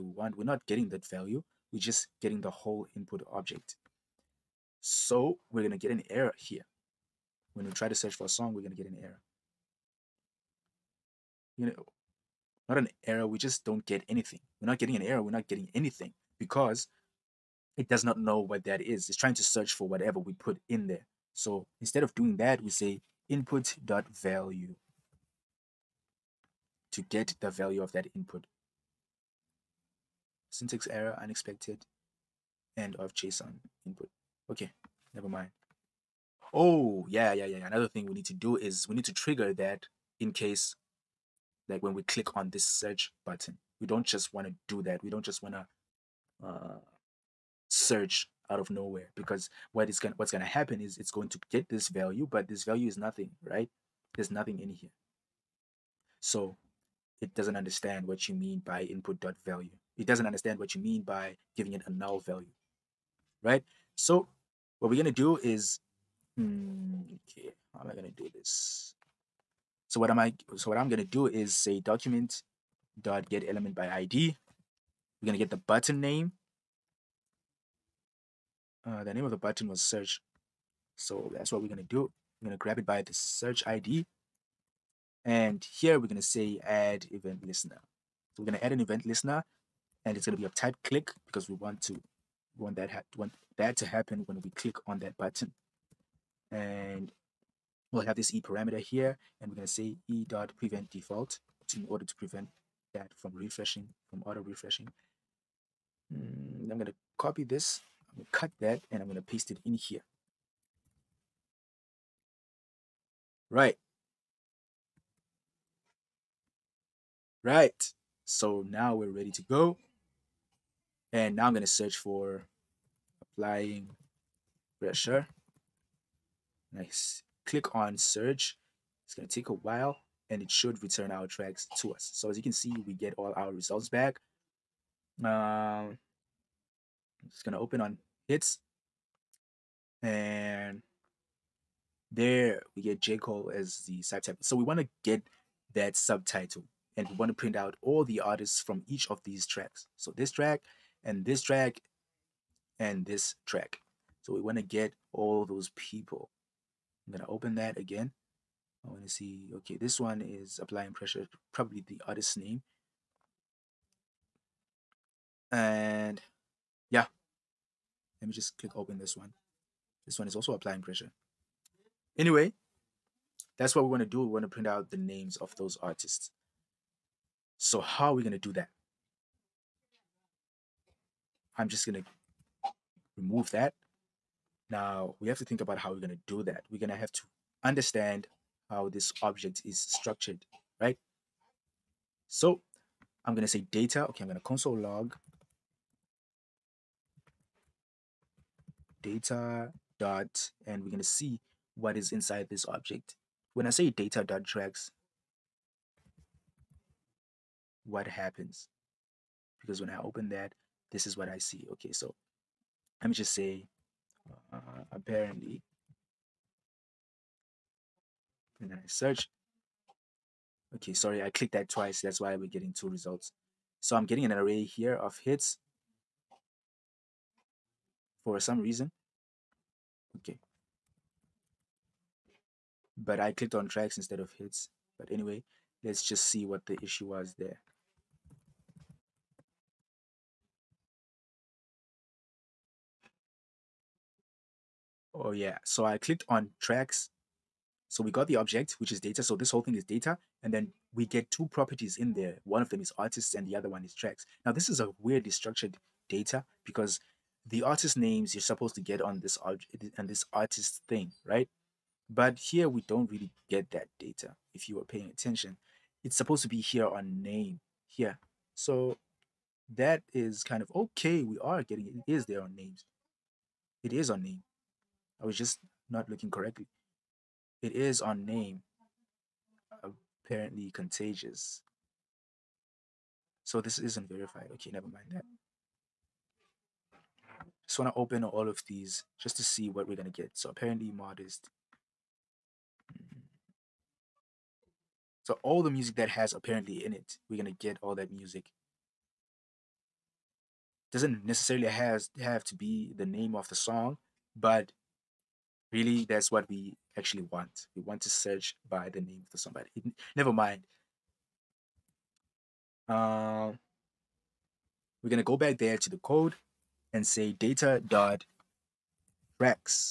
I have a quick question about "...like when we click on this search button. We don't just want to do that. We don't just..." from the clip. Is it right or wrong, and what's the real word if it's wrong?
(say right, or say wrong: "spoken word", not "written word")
right.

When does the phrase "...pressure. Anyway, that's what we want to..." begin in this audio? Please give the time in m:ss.
2:50.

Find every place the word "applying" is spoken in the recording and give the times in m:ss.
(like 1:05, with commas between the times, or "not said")
2:03, 2:40, 2:50.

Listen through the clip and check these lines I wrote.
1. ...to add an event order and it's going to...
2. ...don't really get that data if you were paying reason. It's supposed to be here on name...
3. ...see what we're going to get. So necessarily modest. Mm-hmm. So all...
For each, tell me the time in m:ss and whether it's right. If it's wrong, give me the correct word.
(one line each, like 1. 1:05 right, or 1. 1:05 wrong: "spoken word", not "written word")
1. 1:28 wrong: "listener", not "order"
2. 4:22 wrong: "attention", not "reason"
3. 4:49 wrong: "apparently", not "necessarily".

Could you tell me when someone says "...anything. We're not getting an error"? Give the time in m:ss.
0:14.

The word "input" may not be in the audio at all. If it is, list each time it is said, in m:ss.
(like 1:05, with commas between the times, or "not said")
0:02, 0:23, 0:28, 0:33, 0:58.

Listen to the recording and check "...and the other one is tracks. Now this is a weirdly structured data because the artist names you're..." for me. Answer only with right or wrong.
right.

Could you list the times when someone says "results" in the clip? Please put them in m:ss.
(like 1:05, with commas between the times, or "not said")
2:13, 3:42.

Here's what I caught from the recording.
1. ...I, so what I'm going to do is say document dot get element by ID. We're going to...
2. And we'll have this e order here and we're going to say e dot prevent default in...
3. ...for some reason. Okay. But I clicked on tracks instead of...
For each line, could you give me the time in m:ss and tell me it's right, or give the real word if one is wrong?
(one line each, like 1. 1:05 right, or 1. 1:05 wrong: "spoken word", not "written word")
1. 1:10 right
2. 1:36 wrong: "parameter", not "order"
3. 3:48 right.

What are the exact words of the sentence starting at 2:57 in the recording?
So how are we going to do that?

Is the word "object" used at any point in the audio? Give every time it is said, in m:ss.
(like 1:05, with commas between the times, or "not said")
0:03, 3:09, 3:22, 4:08.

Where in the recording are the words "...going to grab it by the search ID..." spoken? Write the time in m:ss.
1:22.